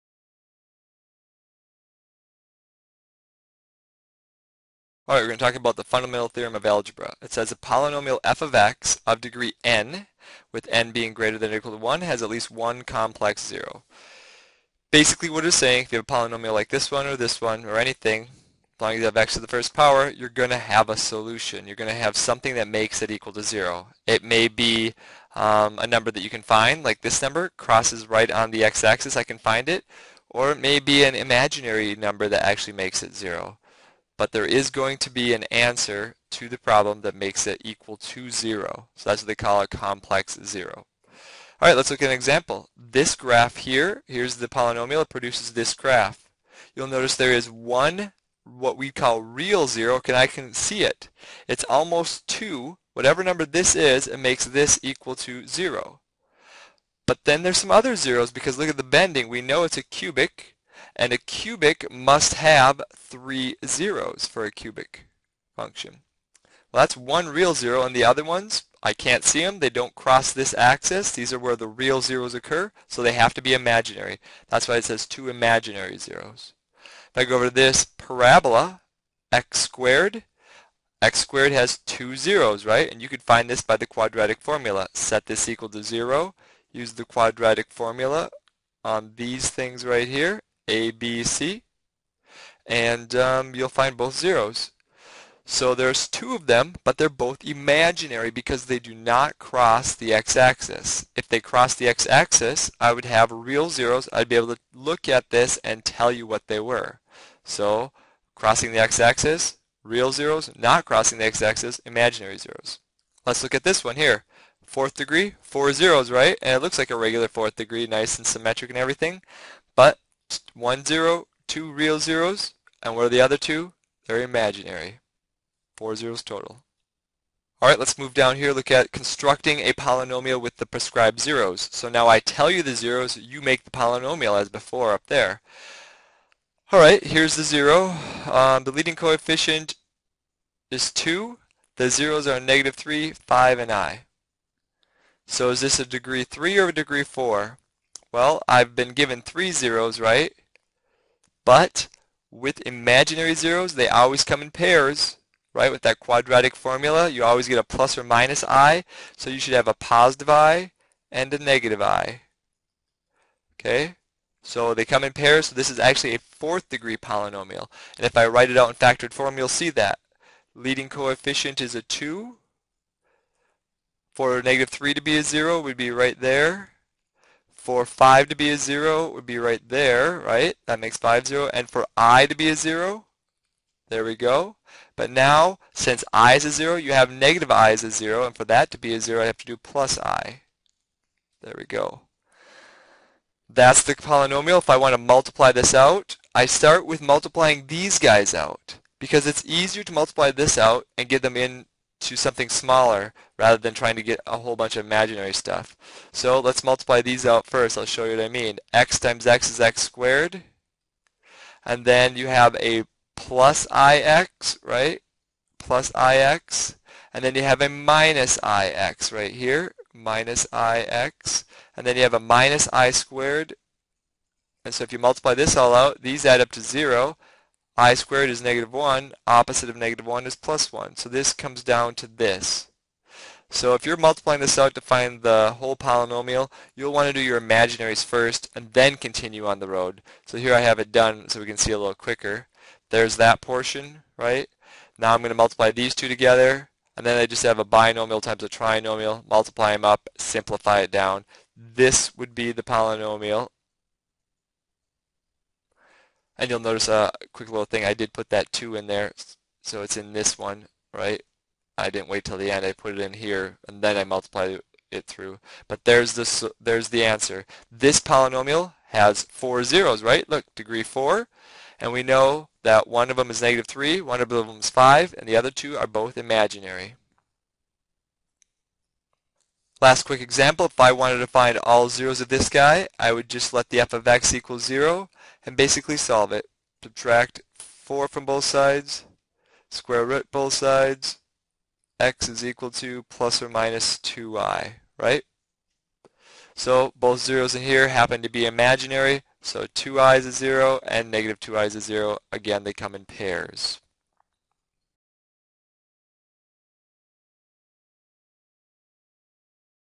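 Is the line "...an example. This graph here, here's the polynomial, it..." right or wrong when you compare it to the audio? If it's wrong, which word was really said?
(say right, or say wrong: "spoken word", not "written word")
right.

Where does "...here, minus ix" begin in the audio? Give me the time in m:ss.
3:39.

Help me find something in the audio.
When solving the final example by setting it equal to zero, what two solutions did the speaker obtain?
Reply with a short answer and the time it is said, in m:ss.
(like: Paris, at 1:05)
plus or minus 2i, at 4:53.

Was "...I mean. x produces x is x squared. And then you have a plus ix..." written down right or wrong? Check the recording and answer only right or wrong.
wrong.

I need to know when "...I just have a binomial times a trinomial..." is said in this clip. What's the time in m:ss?
4:07.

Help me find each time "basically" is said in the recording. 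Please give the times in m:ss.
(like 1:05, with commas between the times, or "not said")
0:14, 4:45.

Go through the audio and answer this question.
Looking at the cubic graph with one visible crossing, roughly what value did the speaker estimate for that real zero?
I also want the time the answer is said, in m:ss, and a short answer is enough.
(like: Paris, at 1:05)
almost 2, at 0:51.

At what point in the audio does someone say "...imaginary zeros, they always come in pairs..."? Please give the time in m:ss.
2:32.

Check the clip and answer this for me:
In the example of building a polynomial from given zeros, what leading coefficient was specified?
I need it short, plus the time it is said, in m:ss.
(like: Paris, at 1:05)
2, at 2:18.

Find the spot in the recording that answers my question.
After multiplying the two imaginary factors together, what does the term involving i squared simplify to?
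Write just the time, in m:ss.
3:50.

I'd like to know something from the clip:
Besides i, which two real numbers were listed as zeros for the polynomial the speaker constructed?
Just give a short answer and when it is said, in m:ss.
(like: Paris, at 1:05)
-3 and 5, at 2:22.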